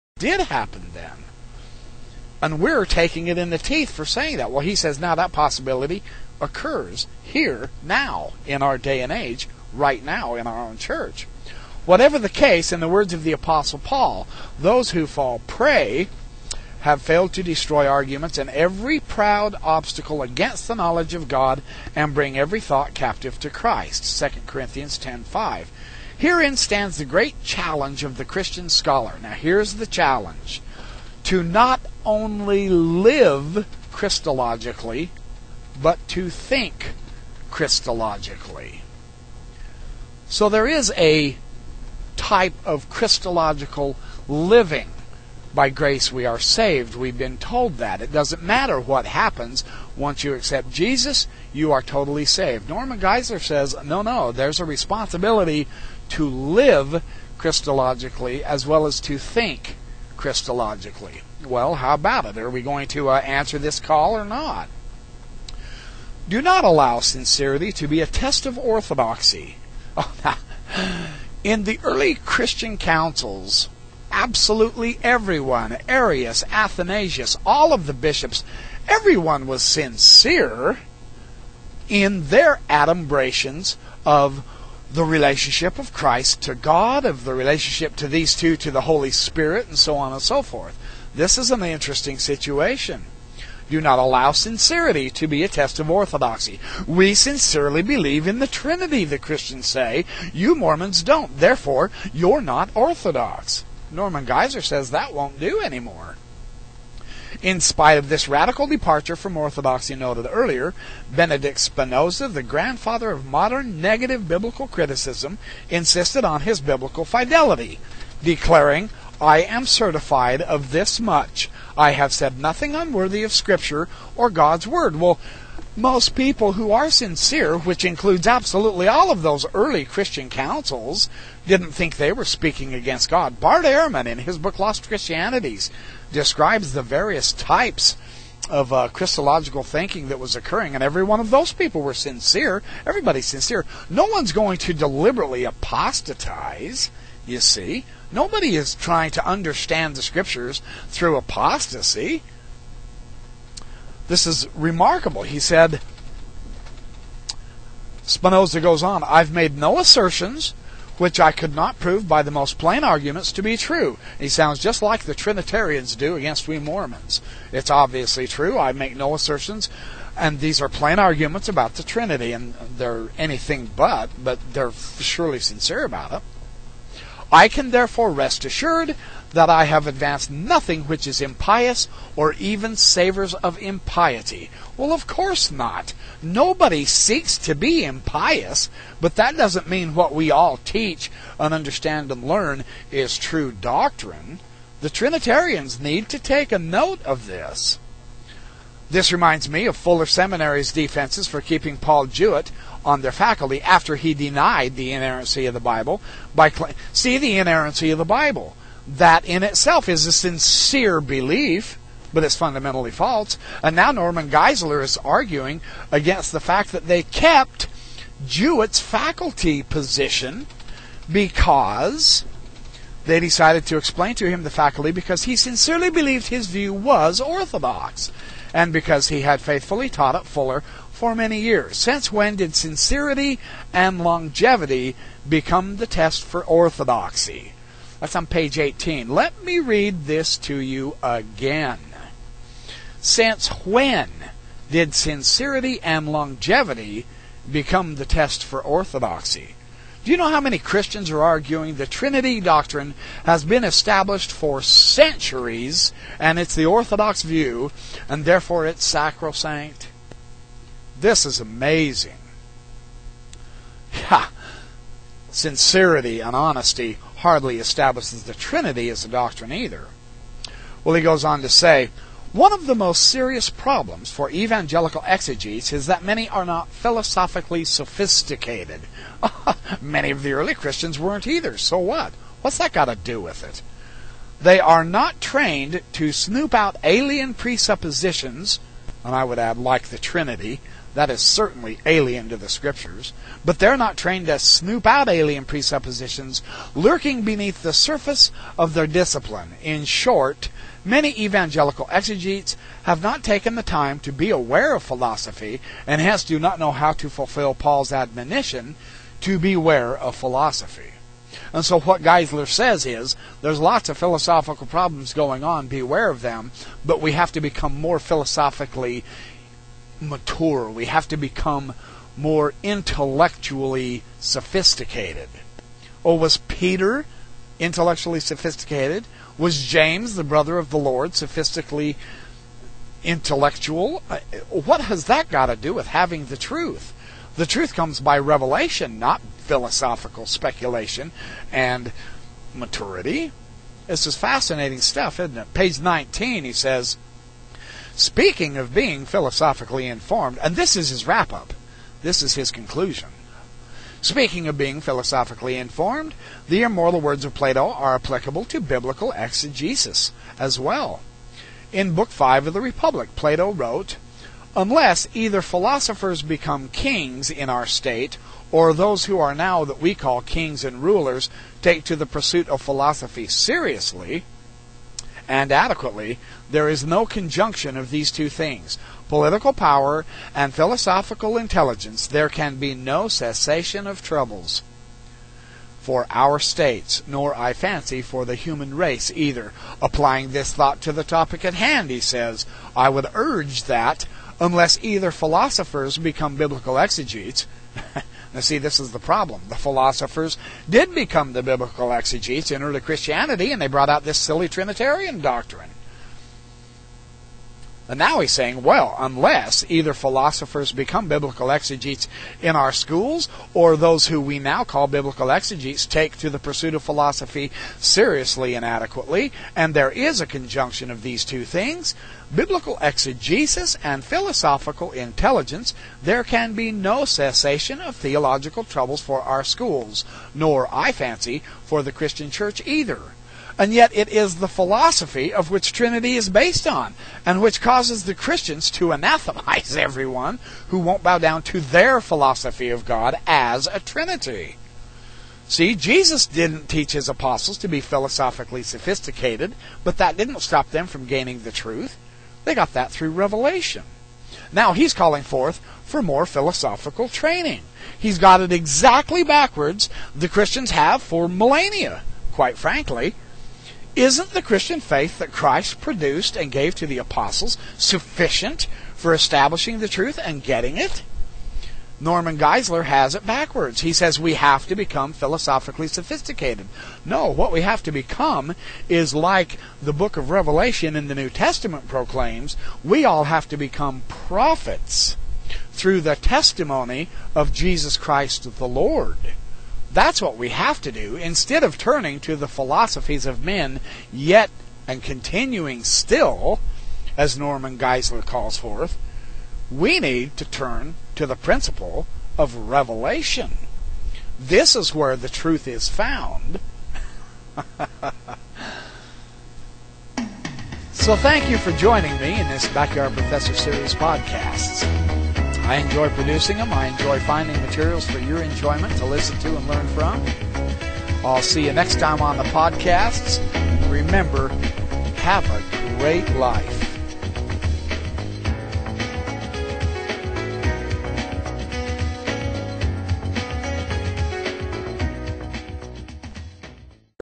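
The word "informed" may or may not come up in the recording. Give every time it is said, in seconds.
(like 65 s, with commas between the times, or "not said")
349 s, 355 s.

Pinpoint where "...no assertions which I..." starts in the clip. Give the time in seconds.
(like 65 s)
159 s.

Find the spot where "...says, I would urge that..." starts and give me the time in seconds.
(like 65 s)
392 s.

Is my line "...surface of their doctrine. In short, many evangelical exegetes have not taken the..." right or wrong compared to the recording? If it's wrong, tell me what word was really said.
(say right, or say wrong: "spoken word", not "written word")
wrong: "discipline", not "doctrine".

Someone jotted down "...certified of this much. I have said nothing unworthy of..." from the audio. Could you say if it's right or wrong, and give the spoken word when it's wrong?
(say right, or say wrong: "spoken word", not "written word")
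right.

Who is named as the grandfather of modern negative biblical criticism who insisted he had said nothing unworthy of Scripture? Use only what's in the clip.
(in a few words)
Benedict Spinoza.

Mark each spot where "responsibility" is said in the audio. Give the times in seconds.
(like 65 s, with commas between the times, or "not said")
54 s.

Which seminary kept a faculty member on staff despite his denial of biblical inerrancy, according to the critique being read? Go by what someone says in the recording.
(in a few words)
Fuller Seminary.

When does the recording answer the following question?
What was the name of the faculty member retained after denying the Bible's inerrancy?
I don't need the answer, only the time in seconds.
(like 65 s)
201 s.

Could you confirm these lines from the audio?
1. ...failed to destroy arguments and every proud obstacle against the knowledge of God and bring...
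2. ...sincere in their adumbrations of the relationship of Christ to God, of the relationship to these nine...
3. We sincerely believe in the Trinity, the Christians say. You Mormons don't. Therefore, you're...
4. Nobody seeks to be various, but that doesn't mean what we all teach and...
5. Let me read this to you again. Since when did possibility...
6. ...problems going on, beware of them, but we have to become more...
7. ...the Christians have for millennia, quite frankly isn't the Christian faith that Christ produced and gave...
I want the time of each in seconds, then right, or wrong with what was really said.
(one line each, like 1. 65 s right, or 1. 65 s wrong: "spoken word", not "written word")
1. 17 s right
2. 79 s wrong: "two", not "nine"
3. 96 s right
4. 186 s wrong: "impious", not "various"
5. 239 s wrong: "sincerity", not "possibility"
6. 314 s right
7. 460 s right.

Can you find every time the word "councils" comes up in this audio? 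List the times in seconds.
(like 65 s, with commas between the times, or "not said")
72 s, 130 s.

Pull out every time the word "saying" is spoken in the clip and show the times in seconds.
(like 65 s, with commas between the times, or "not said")
4 s, 408 s.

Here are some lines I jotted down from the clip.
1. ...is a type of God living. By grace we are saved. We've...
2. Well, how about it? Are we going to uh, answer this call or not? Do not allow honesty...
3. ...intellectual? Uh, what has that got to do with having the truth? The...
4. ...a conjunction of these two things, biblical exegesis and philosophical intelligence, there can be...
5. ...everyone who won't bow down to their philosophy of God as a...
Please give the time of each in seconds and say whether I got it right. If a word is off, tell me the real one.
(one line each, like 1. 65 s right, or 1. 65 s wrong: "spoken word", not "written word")
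1. 40 s wrong: "Christological", not "God"
2. 61 s wrong: "sincerity", not "honesty"
3. 333 s right
4. 420 s right
5. 439 s right.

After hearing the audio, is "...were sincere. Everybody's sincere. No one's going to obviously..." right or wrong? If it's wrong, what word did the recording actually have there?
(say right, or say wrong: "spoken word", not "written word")
wrong: "deliberately", not "obviously".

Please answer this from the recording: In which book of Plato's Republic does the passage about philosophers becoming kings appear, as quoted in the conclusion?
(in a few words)
Book 5.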